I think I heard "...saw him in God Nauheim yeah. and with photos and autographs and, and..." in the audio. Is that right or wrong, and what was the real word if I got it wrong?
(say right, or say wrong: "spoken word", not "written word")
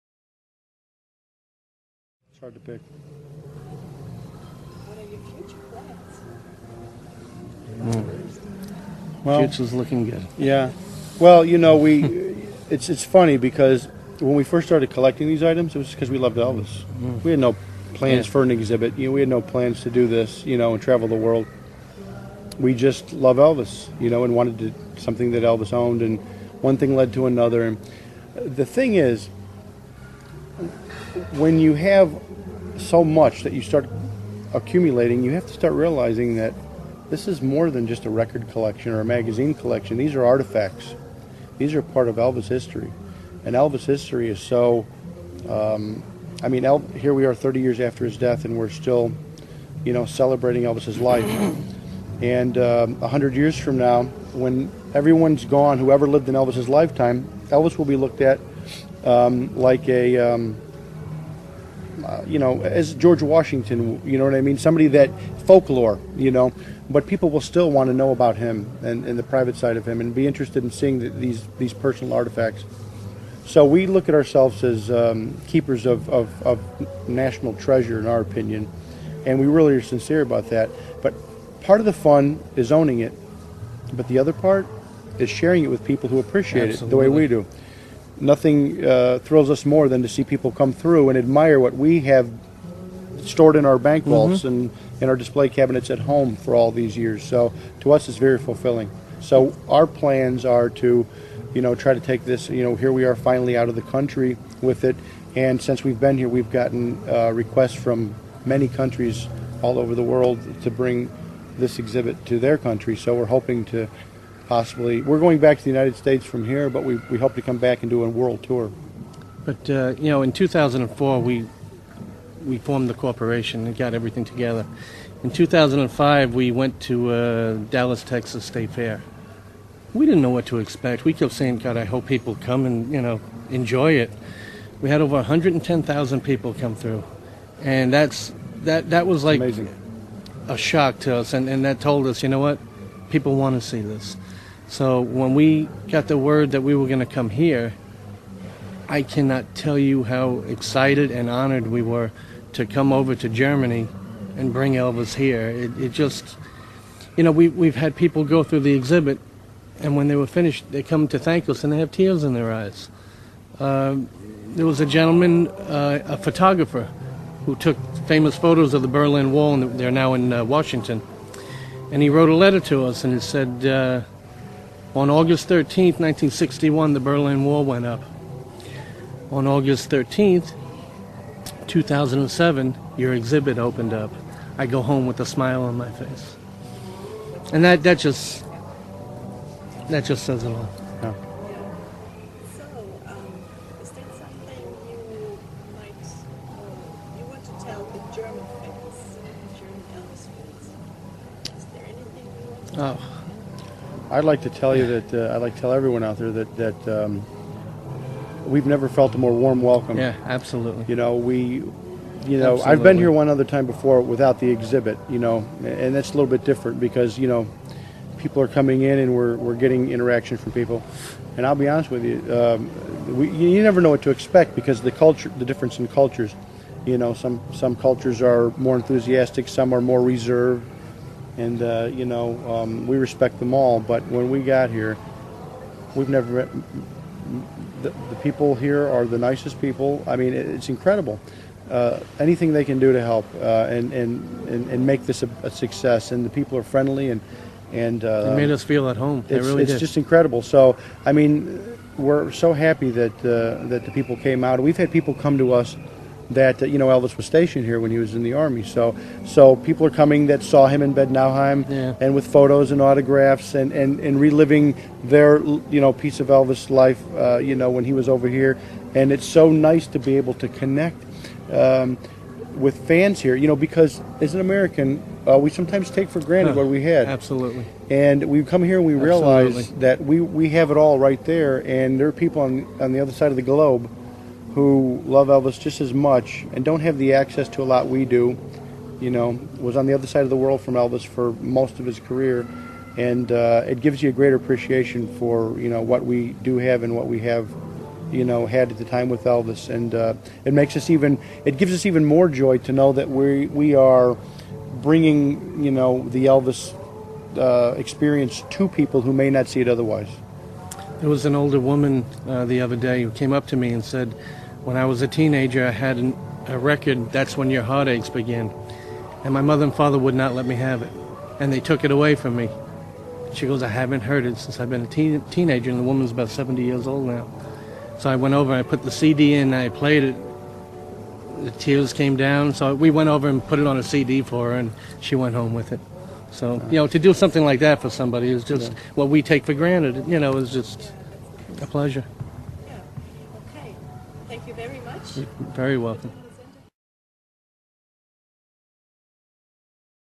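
wrong: "Bad", not "God".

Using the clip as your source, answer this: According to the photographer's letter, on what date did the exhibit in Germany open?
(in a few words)
August 13, 2007.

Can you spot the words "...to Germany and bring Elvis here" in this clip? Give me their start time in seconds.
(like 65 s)
153 s.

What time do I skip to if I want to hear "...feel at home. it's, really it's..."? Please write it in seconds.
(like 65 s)
248 s.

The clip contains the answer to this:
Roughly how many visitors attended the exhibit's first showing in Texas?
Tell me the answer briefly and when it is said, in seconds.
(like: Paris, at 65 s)
110,000, at 135 s.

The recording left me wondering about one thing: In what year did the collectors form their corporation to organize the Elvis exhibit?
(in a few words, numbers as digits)
2004.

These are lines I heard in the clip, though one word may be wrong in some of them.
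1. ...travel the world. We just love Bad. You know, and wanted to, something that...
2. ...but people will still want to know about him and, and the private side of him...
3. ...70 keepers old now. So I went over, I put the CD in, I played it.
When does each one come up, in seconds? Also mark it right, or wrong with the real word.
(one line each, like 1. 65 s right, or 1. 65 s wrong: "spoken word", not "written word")
1. 20 s wrong: "Elvis", not "Bad"
2. 66 s right
3. 326 s wrong: "years", not "keepers".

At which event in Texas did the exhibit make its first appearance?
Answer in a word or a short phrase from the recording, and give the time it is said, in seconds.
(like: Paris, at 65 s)
Dallas, Texas State Fair, at 127 s.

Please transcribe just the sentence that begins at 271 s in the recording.
Um, with fans here, you know, because as an American, uh, we sometimes take for granted huh, what we had.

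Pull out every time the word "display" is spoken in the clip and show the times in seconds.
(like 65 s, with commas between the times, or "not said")
95 s.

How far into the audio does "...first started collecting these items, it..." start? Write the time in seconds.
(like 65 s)
14 s.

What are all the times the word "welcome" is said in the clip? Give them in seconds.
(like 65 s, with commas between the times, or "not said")
209 s, 345 s.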